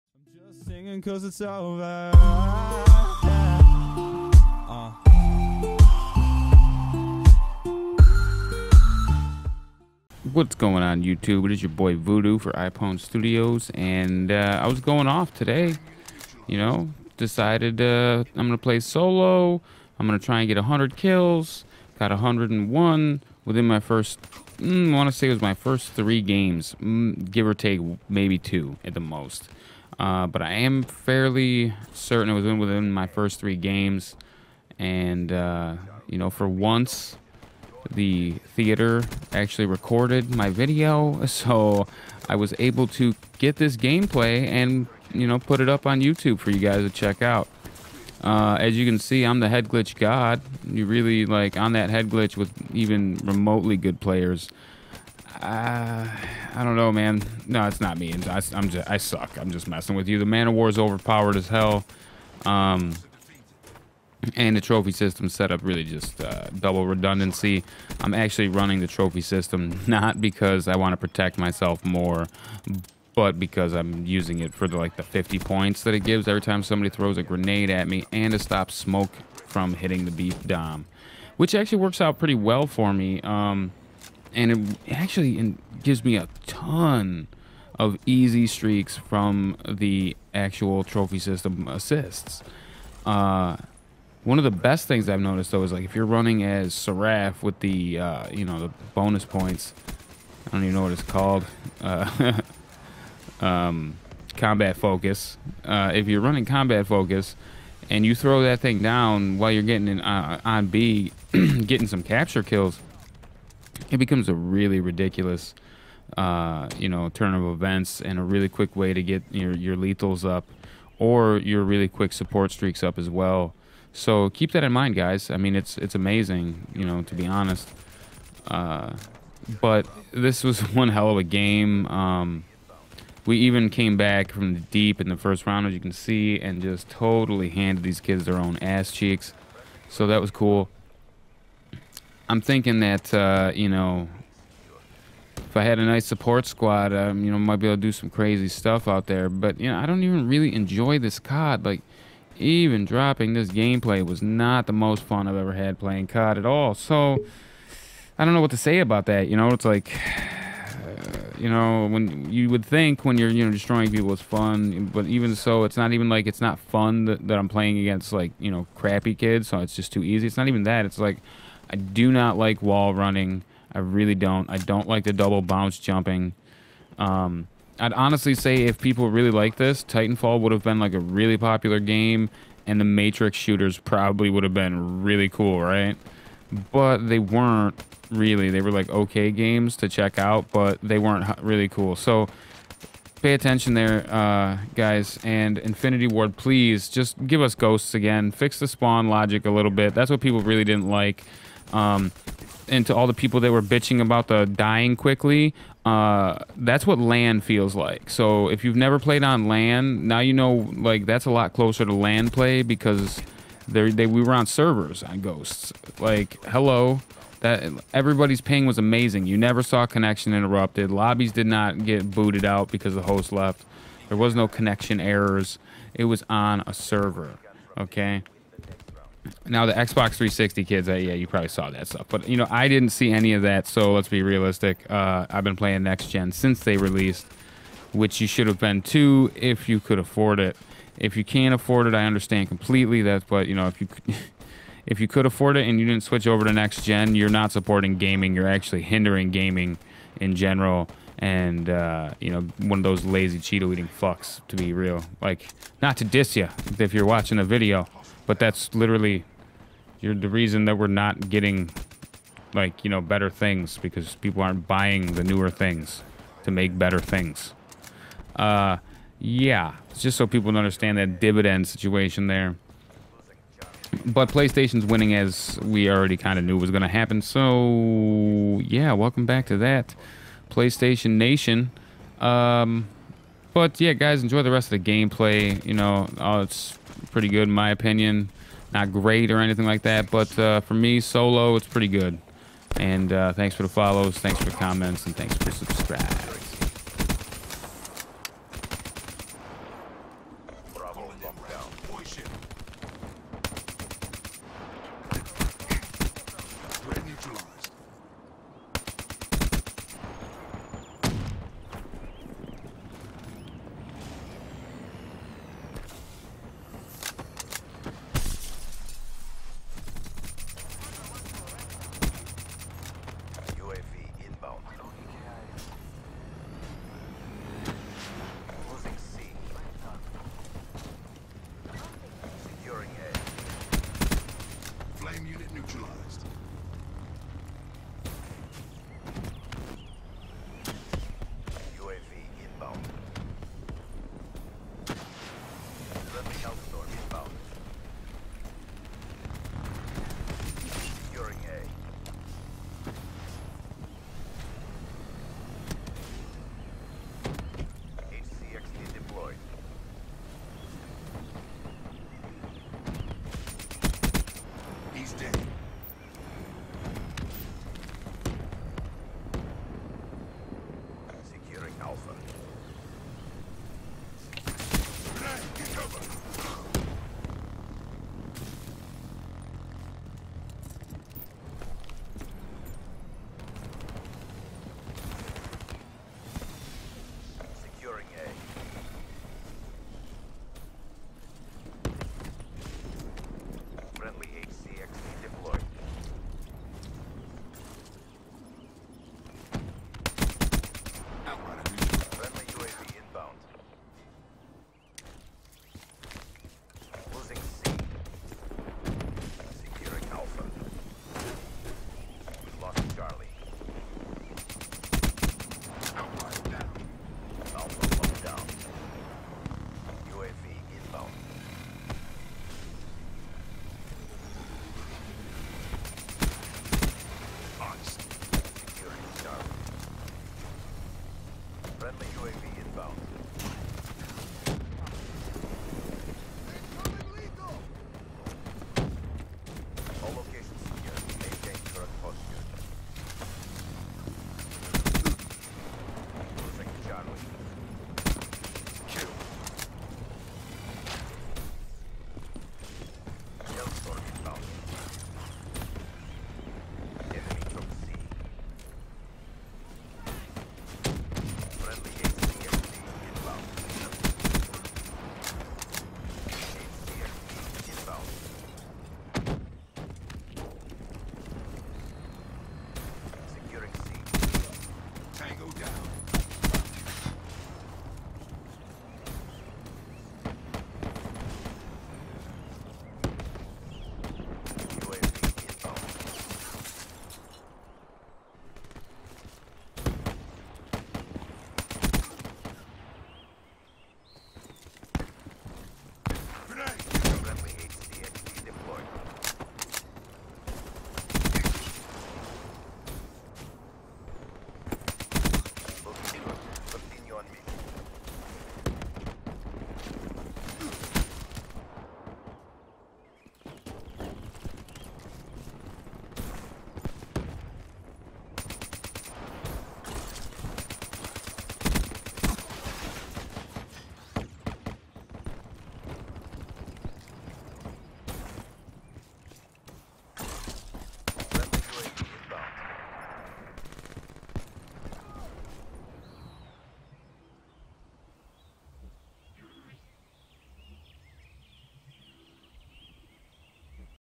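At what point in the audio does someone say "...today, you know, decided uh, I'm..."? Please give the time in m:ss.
0:15.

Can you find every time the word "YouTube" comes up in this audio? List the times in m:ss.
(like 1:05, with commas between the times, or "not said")
0:11, 0:46.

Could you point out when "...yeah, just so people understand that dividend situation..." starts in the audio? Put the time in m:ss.
4:29.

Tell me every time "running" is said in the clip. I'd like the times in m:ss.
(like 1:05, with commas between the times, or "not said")
1:08, 1:36, 1:46, 2:52.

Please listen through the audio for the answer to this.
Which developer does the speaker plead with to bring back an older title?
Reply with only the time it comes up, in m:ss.
3:15.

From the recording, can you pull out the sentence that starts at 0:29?
Uh, but I am fairly certain it was within my first three games.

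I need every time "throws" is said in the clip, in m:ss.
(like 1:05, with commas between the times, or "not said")
1:16, 1:48.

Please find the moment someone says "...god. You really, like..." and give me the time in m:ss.
0:49.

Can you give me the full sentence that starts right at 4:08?
You're actually hindering gaming in general and uh, you know one of those lazy Cheeto eating fucks to be real.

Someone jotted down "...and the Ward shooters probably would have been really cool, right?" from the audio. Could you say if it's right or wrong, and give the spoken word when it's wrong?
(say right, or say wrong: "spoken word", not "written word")
wrong: "Matrix", not "Ward".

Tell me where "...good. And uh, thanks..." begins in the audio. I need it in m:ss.
4:51.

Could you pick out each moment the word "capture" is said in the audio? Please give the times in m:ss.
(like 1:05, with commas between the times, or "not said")
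1:52.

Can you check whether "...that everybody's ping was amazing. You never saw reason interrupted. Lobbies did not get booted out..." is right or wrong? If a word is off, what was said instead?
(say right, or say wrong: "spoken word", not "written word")
wrong: "connection", not "reason".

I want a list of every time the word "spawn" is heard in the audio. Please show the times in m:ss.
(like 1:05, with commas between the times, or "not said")
3:18.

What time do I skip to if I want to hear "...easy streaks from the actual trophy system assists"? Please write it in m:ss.
1:28.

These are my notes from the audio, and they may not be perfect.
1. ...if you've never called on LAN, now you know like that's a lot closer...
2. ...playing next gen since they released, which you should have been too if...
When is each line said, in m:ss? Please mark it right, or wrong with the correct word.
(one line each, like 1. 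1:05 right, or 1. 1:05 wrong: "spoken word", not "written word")
1. 3:28 wrong: "played", not "called"
2. 3:55 right.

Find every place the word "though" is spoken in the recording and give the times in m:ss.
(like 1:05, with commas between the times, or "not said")
1:35.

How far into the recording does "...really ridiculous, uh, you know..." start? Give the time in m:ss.
1:54.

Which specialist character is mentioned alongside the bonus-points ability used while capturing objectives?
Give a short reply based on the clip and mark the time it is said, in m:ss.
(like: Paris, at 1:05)
Seraph, at 1:36.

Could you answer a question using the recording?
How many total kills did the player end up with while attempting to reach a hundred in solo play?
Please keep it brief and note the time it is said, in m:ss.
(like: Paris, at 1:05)
101, at 0:22.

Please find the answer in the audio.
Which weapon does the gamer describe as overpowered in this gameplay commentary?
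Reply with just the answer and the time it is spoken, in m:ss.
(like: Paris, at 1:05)
Man-O-War, at 1:00.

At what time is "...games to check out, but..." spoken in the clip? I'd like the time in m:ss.
3:09.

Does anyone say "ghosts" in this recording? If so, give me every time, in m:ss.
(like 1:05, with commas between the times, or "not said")
3:17, 3:35.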